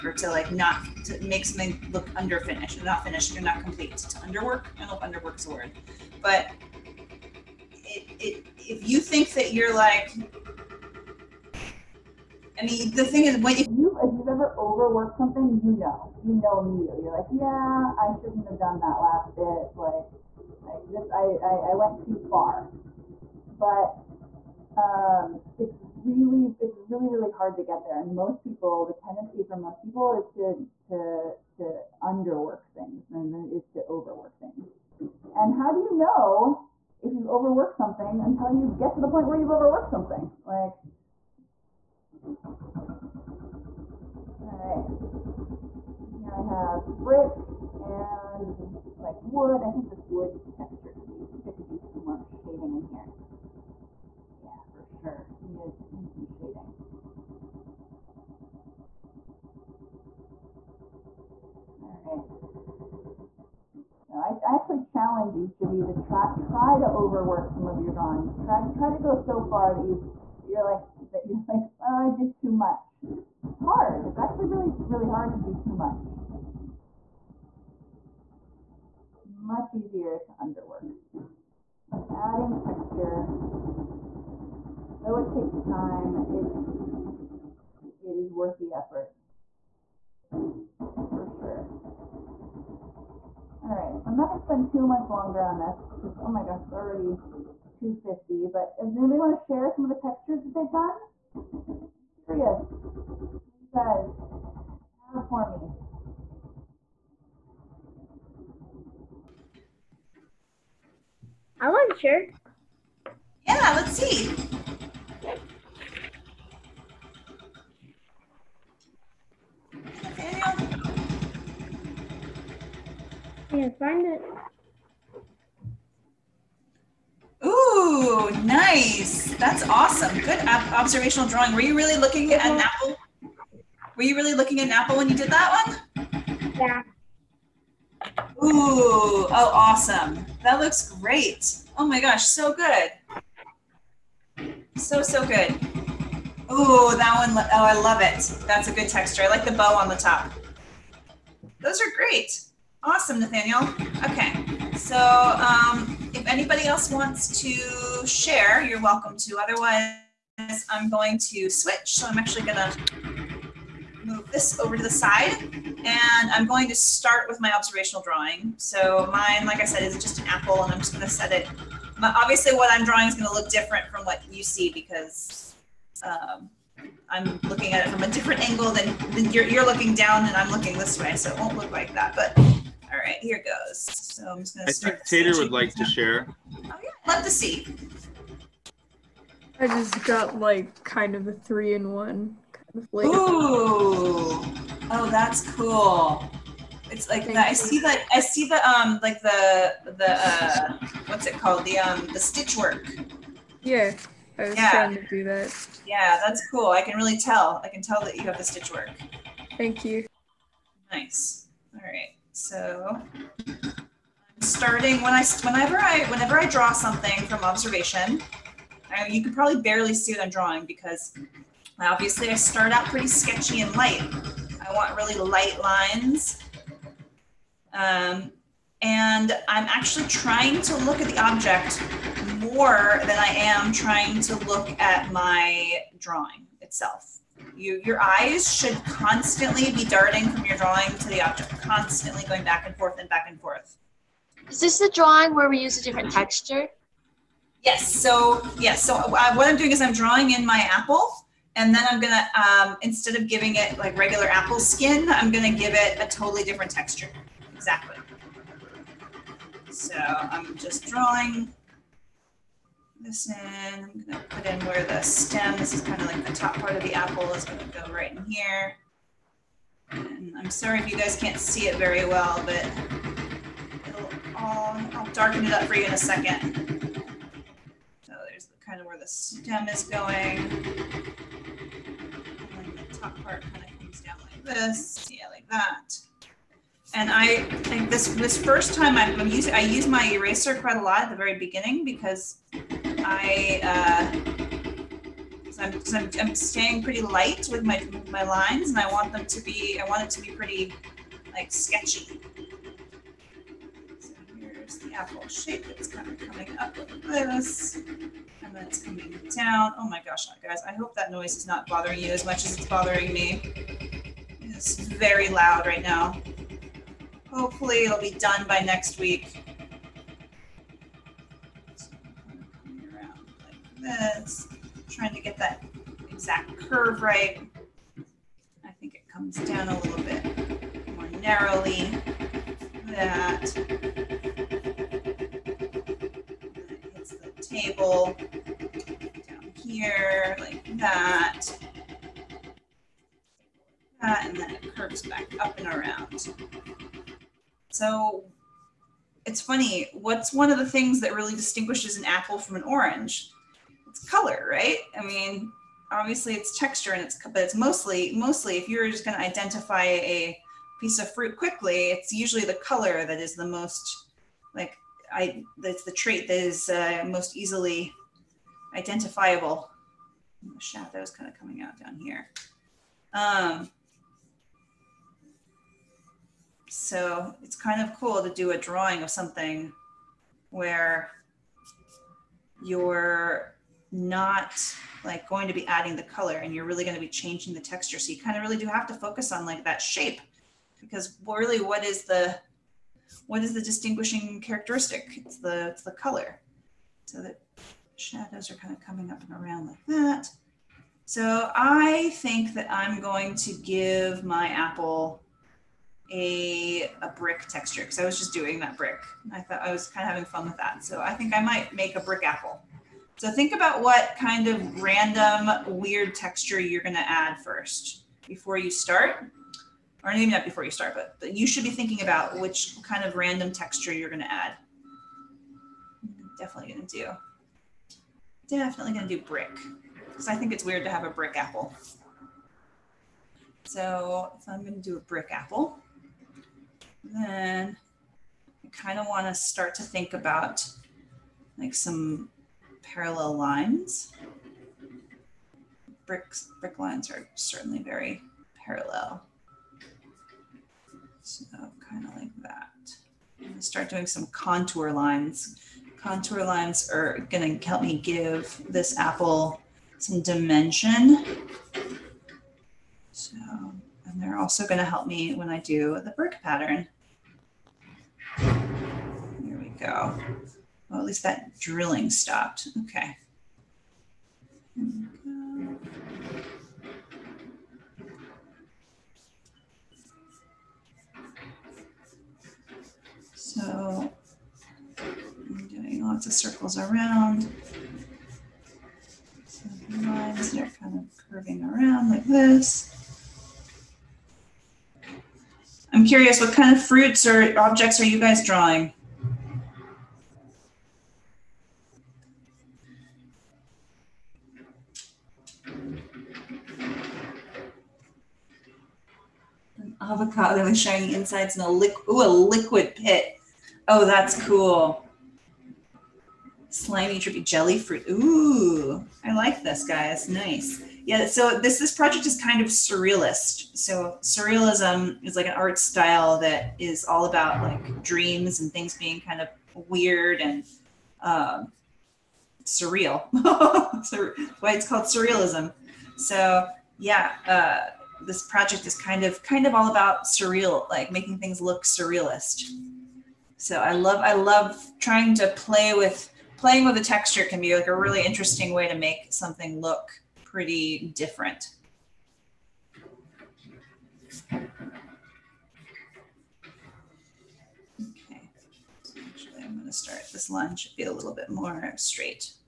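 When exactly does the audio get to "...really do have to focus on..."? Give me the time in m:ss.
6:28.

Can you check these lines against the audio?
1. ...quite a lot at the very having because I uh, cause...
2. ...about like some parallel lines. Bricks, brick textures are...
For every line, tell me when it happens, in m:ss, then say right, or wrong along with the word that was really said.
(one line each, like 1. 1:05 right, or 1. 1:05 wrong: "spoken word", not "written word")
1. 4:50 wrong: "beginning", not "having"
2. 7:20 wrong: "lines", not "textures".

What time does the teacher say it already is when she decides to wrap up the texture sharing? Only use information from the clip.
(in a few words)
2:50.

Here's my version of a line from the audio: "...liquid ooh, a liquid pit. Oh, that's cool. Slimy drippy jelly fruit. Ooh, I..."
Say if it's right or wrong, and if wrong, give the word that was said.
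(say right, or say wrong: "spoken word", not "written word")
right.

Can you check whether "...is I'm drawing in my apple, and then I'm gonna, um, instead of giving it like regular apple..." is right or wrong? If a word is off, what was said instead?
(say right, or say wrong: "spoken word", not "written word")
right.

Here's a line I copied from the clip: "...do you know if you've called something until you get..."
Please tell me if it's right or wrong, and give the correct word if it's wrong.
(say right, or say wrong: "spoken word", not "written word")
wrong: "overworked", not "called".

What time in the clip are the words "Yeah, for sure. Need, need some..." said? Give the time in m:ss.
0:54.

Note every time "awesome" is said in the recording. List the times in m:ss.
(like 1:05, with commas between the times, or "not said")
2:09, 2:19, 2:32.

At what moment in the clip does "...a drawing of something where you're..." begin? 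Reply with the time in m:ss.
6:18.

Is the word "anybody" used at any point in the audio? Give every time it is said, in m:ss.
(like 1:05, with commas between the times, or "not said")
1:38, 2:36.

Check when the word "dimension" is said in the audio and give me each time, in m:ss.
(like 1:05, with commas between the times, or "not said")
7:40.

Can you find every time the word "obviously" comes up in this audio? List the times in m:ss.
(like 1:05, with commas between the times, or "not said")
2:52, 3:41, 5:55.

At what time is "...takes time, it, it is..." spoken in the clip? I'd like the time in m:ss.
1:25.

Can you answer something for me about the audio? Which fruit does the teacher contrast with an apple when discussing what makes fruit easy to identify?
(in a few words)
An orange.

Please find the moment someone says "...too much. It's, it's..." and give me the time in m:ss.
1:12.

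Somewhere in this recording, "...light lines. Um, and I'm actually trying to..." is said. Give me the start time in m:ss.
3:45.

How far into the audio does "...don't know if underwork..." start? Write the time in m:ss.
0:04.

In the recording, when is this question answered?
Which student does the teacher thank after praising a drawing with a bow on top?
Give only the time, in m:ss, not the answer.
2:33.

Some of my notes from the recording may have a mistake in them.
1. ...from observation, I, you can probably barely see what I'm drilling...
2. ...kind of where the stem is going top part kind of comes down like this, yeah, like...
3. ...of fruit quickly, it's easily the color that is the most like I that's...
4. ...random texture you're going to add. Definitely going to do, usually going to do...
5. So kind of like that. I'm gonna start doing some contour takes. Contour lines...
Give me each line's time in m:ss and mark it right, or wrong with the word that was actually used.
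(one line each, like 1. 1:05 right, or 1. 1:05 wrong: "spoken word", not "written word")
1. 3:37 wrong: "drawing", not "drilling"
2. 4:38 right
3. 6:00 wrong: "usually", not "easily"
4. 7:03 wrong: "definitely", not "usually"
5. 7:31 wrong: "lines", not "takes".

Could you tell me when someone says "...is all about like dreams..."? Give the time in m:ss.
8:46.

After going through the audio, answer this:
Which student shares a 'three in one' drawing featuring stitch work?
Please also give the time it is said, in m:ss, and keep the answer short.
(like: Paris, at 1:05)
Tater, at 3:05.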